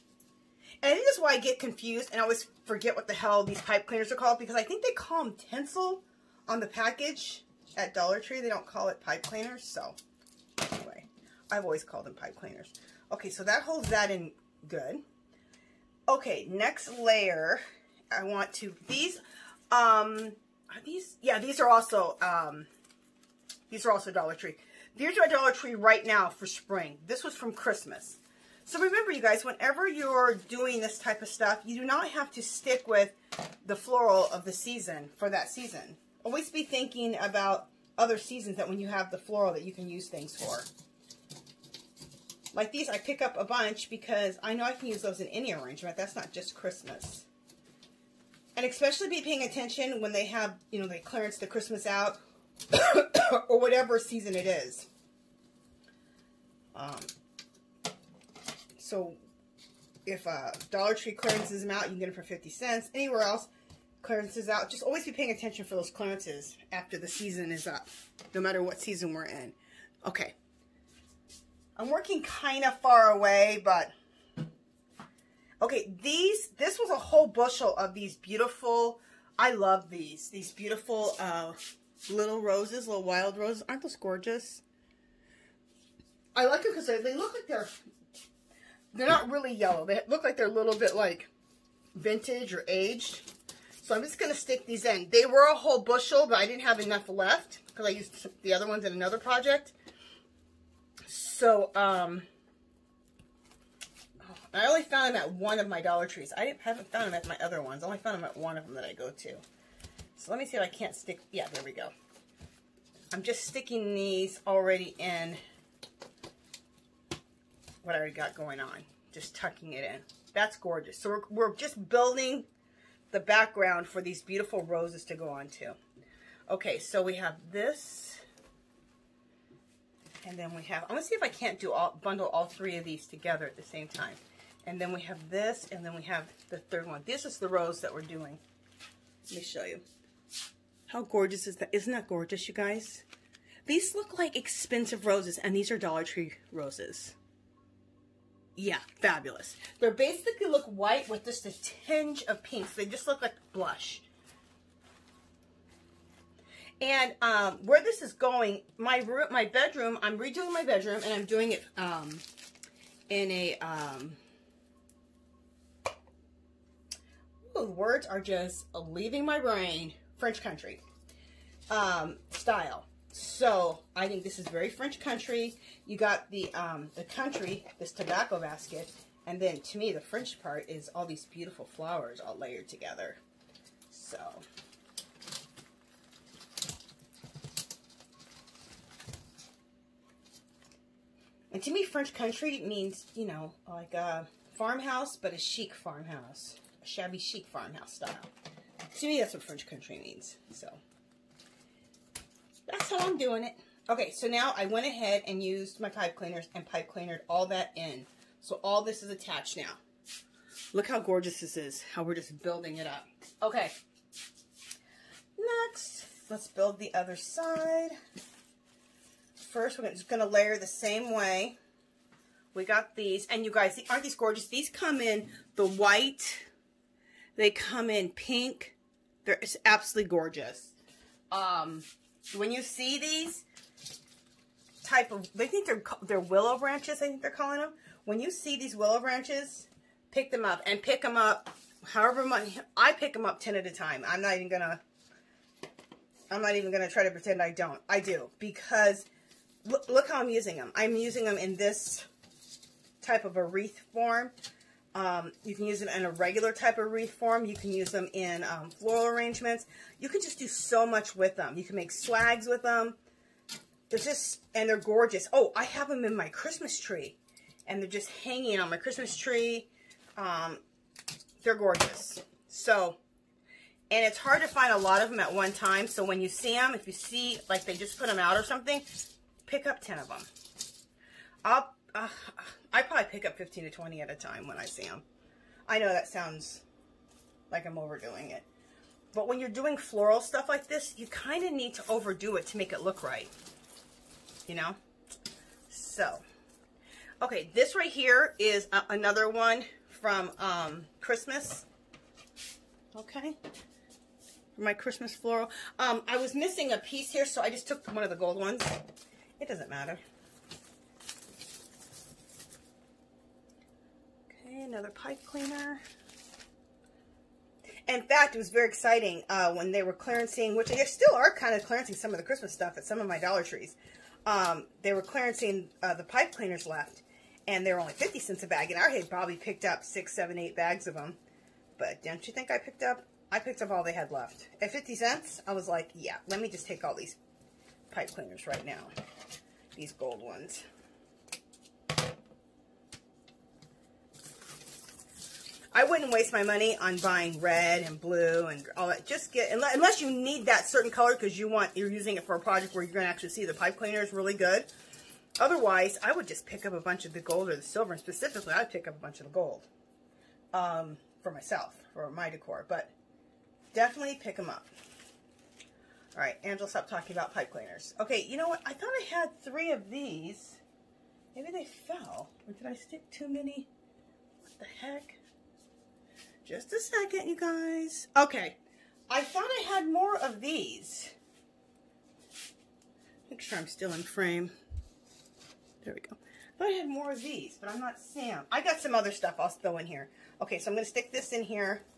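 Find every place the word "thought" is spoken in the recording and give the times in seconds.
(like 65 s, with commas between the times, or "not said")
368 s, 379 s, 386 s.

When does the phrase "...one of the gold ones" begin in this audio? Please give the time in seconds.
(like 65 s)
307 s.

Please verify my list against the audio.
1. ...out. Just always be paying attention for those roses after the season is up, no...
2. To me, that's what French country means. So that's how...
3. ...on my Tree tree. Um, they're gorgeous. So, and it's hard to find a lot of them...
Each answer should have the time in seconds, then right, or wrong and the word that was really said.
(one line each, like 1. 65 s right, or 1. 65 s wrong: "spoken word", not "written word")
1. 64 s wrong: "clearances", not "roses"
2. 198 s right
3. 268 s wrong: "Christmas", not "Tree".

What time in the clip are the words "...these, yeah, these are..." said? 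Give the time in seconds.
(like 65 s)
20 s.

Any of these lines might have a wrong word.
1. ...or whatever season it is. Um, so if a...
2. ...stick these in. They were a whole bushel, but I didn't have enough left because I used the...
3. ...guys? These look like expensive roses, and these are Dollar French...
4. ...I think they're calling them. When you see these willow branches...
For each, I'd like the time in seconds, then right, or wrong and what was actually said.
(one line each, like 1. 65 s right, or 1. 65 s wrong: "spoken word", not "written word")
1. 53 s right
2. 94 s right
3. 142 s wrong: "Tree", not "French"
4. 237 s right.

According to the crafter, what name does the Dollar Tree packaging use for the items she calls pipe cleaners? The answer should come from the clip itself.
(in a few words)
tinsel.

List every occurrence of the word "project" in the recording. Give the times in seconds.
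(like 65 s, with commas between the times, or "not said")
99 s, 352 s.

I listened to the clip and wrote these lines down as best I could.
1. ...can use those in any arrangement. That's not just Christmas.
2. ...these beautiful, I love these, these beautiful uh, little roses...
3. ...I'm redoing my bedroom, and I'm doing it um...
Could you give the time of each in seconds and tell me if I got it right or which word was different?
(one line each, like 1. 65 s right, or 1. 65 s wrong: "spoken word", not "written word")
1. 44 s right
2. 77 s right
3. 160 s right.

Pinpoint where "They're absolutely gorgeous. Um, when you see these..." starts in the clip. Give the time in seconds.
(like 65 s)
229 s.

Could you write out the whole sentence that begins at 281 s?
I'll, uh, I probably pick up 15 to 20 at a time when I see them.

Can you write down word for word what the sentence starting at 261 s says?
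You can make swags with them.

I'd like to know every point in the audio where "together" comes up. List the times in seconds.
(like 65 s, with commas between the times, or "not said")
133 s, 182 s.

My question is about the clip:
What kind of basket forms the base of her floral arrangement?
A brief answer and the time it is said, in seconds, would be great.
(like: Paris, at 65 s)
tobacco basket, at 177 s.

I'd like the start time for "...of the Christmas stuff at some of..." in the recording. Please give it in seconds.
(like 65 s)
322 s.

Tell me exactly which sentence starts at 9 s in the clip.
So anyway, I've always called them pipe cleaners.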